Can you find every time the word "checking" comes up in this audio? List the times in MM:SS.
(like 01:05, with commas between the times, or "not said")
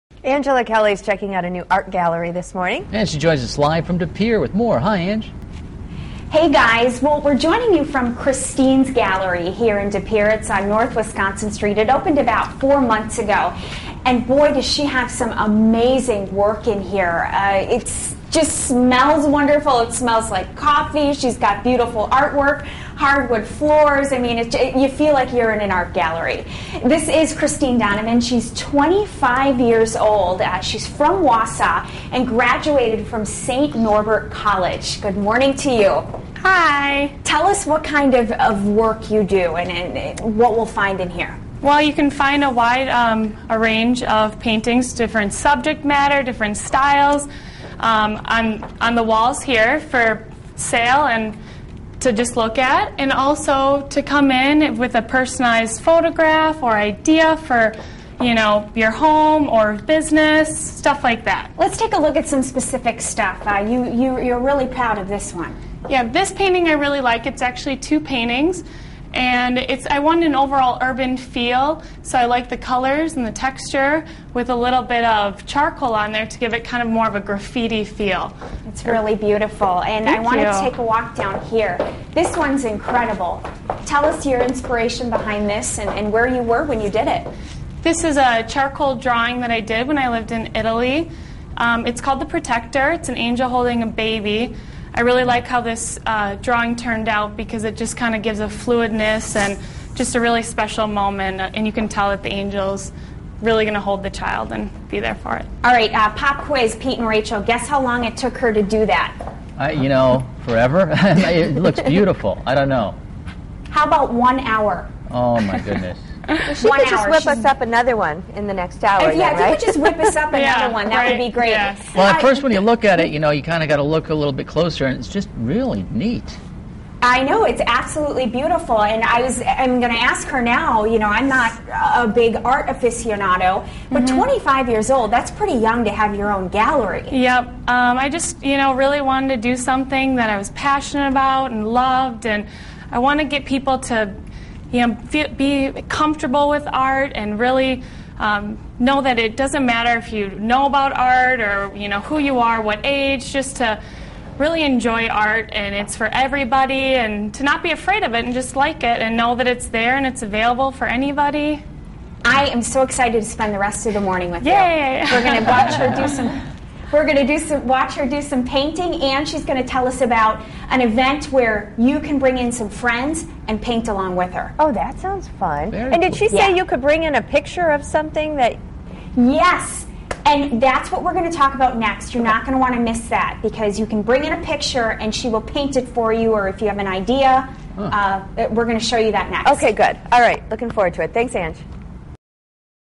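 00:01.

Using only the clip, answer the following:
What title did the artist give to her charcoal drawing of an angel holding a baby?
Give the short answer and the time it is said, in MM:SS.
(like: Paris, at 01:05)
The Protector, at 01:32.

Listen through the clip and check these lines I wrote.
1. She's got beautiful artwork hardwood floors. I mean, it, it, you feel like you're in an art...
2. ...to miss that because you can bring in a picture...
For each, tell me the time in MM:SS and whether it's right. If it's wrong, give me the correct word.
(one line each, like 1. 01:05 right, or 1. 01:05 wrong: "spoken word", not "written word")
1. 00:21 right
2. 03:02 right.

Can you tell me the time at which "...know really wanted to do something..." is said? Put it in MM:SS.
02:18.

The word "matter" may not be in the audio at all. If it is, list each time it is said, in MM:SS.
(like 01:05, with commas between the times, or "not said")
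00:45, 02:29.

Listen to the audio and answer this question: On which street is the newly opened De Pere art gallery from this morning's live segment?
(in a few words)
North Wisconsin Street.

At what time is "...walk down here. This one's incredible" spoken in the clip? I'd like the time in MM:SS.
01:20.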